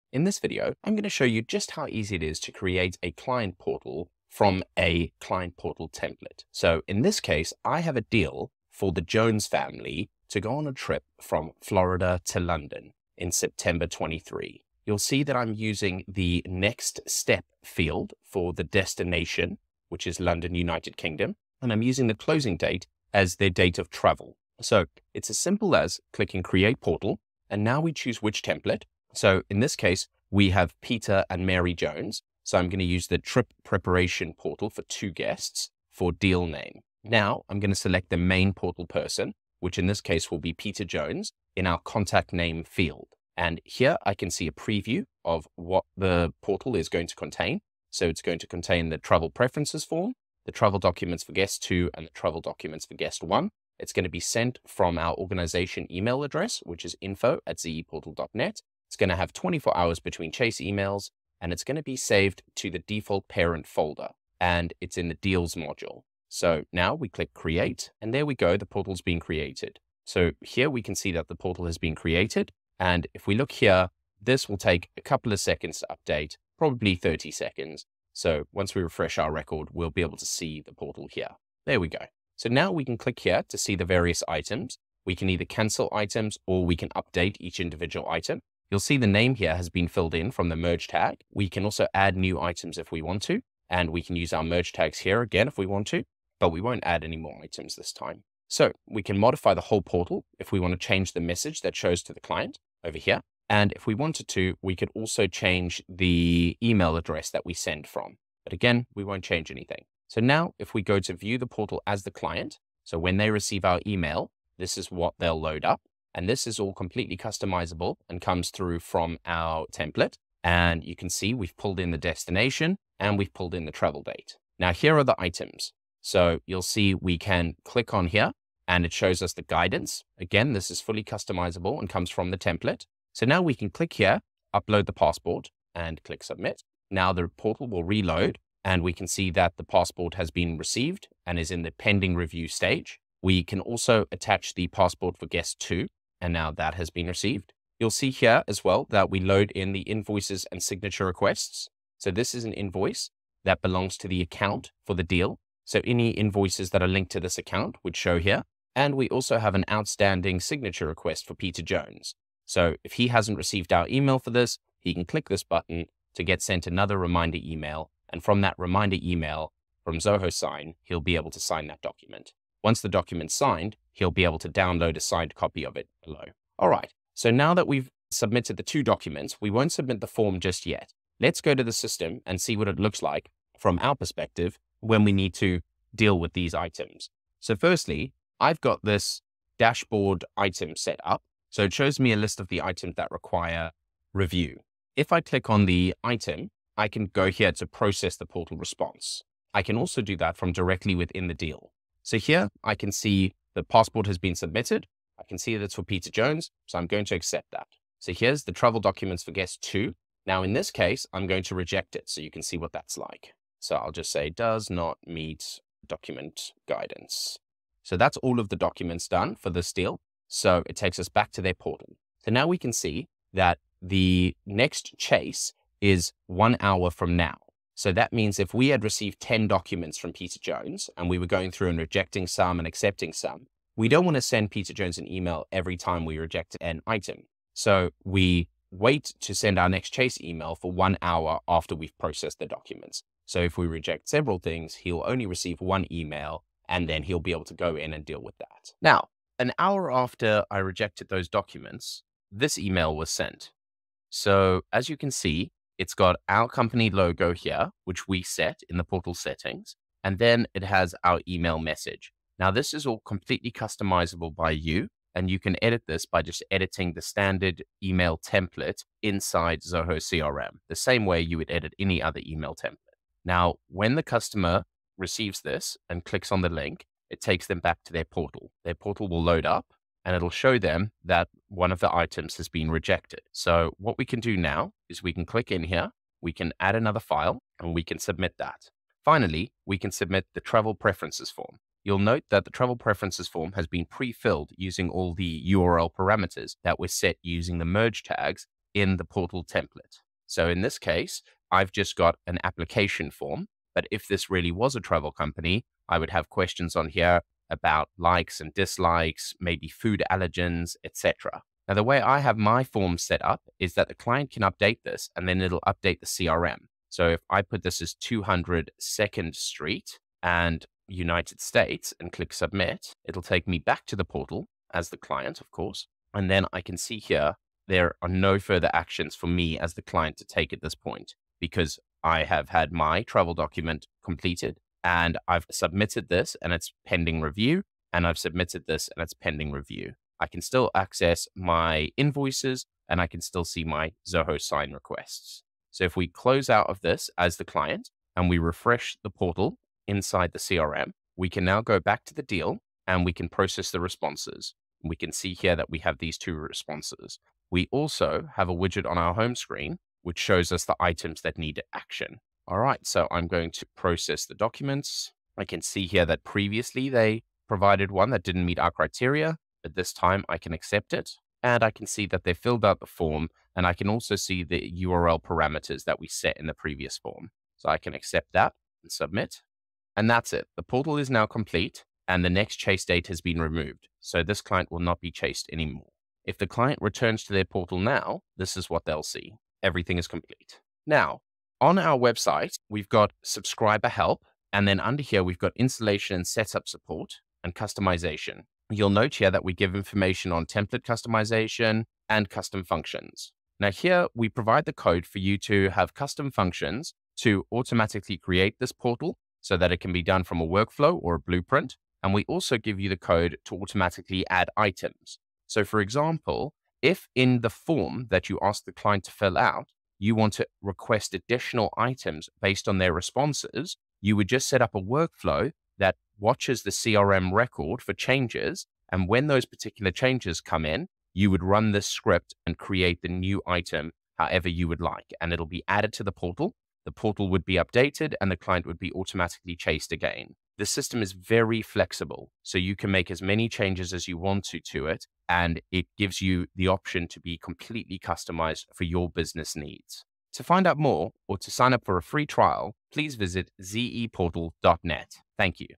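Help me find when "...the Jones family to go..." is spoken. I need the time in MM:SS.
00:08.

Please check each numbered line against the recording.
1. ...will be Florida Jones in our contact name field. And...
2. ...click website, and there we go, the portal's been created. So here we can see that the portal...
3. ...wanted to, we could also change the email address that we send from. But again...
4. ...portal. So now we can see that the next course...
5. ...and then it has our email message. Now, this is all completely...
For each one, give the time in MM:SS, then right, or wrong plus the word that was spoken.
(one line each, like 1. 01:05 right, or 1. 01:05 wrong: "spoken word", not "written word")
1. 00:40 wrong: "Peter", not "Florida"
2. 01:07 wrong: "create", not "website"
3. 01:43 right
4. 03:41 wrong: "chase", not "course"
5. 04:20 right.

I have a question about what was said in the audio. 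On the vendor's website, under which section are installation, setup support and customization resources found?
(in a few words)
Subscriber help.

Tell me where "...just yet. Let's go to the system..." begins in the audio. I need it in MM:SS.
03:00.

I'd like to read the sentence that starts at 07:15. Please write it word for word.
And it'll be added to the portal.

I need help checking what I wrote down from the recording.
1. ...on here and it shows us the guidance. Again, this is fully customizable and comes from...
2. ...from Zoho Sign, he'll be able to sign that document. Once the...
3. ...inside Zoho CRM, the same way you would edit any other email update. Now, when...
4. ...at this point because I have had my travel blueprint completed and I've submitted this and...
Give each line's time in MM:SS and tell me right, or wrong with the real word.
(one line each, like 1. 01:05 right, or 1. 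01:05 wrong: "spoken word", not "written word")
1. 02:07 right
2. 02:49 right
3. 04:29 wrong: "template", not "update"
4. 05:30 wrong: "document", not "blueprint".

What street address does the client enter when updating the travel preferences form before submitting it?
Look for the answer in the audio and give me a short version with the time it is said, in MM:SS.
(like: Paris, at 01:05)
200 Second Street, at 05:17.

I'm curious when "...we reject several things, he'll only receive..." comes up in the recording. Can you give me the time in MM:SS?
04:03.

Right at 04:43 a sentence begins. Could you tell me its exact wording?
So what we can do now is we can click in here, we can add another file, and we can submit that.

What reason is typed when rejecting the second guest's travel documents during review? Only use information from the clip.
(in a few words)
Does not meet document guidance.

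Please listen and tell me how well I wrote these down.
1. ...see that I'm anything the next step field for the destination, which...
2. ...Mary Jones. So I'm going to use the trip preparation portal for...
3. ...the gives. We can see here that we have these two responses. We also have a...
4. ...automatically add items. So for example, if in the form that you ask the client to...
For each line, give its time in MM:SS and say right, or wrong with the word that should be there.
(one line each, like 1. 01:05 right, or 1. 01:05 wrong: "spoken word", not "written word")
1. 00:14 wrong: "using", not "anything"
2. 00:31 right
3. 05:53 wrong: "responses", not "gives"
4. 06:53 right.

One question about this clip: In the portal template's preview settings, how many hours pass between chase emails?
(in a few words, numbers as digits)
24.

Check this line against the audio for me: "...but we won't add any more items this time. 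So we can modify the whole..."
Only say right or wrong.
right.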